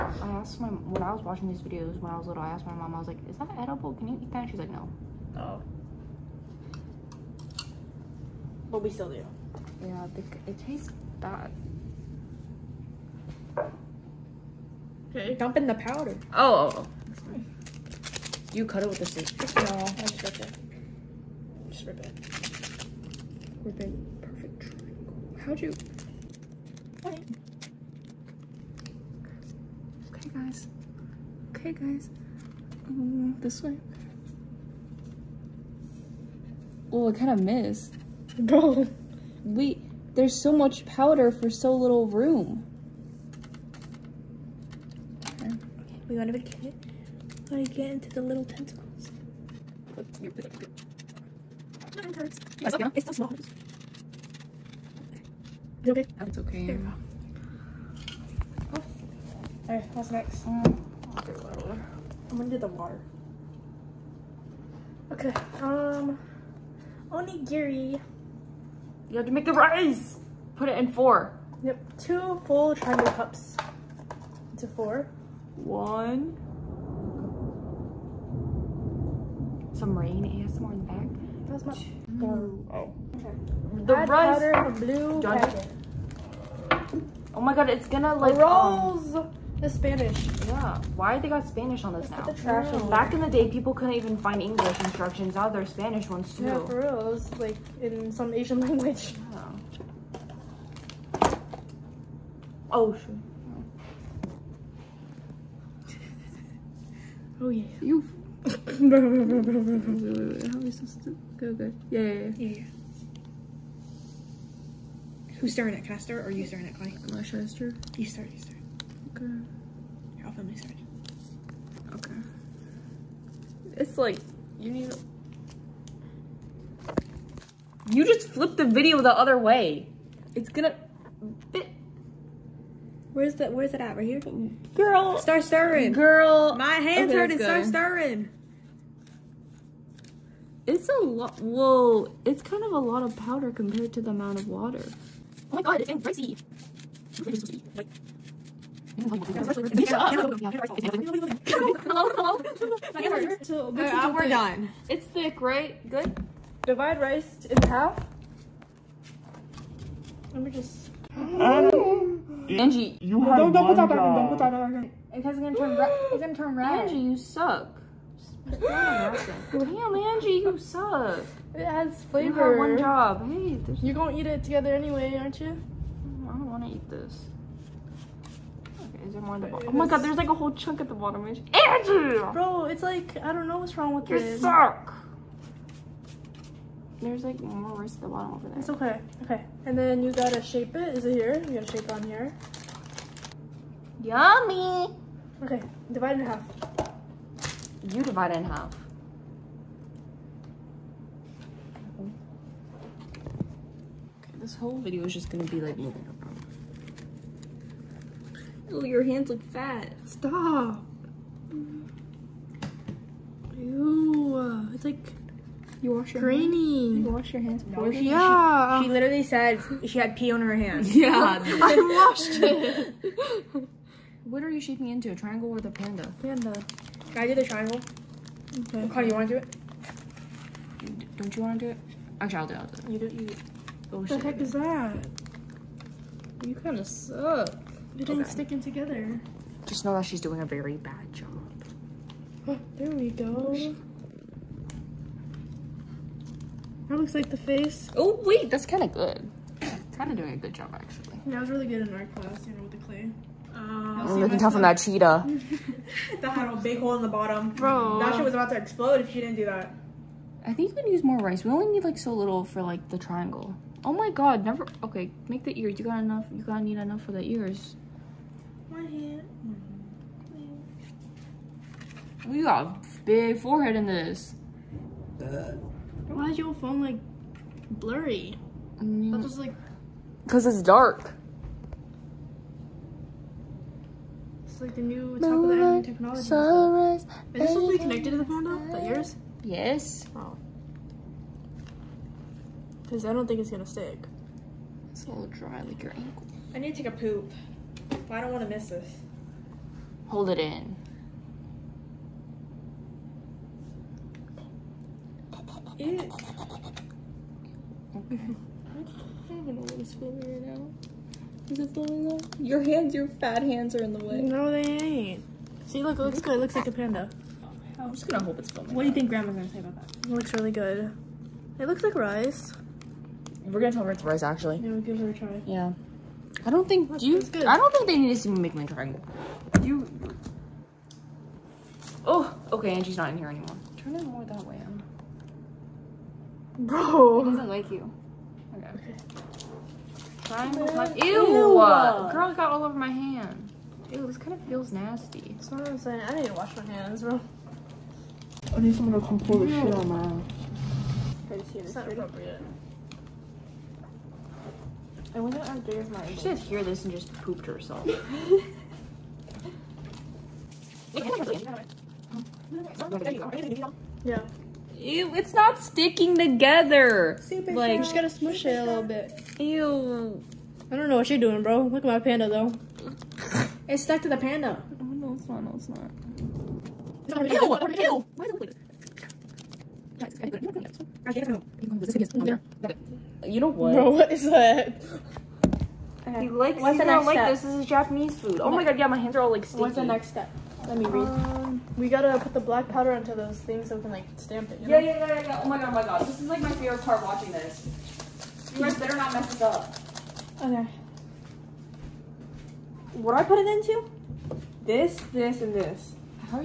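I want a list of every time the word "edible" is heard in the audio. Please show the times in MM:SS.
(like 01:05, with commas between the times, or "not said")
00:03.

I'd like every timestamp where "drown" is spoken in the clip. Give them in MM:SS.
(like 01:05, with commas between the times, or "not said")
not said.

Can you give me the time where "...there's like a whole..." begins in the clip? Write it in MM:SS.
02:59.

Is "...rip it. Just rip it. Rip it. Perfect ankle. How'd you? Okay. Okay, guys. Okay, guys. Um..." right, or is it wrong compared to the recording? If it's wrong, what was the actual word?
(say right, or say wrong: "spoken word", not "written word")
wrong: "triangle", not "ankle".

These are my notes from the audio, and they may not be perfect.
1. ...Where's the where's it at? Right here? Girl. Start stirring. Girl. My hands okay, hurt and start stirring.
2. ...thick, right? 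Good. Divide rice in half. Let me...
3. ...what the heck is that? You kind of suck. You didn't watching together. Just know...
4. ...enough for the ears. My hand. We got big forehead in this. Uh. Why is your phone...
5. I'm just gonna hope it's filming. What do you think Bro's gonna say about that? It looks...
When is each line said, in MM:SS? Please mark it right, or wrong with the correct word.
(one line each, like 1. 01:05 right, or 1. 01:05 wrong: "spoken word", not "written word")
1. 02:13 right
2. 02:35 right
3. 03:53 wrong: "sticking", not "watching"
4. 04:26 right
5. 05:17 wrong: "Grandma", not "Bro".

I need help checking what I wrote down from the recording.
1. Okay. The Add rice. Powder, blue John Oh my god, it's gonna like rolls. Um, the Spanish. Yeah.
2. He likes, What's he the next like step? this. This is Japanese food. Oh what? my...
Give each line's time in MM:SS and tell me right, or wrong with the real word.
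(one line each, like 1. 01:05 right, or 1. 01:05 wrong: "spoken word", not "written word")
1. 01:23 right
2. 06:26 right.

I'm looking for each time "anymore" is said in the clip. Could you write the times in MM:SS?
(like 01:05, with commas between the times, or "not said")
05:33.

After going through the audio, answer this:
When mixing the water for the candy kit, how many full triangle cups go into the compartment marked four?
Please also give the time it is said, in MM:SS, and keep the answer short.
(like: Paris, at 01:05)
2, at 01:11.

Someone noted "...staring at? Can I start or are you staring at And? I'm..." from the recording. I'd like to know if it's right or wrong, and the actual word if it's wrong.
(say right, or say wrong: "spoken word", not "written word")
wrong: "Clay", not "And".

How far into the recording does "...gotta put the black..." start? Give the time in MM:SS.
06:31.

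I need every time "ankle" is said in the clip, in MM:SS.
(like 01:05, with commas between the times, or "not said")
04:55.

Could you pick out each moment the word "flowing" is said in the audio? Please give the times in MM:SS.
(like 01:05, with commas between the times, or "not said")
05:11.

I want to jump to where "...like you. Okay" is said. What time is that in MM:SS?
05:37.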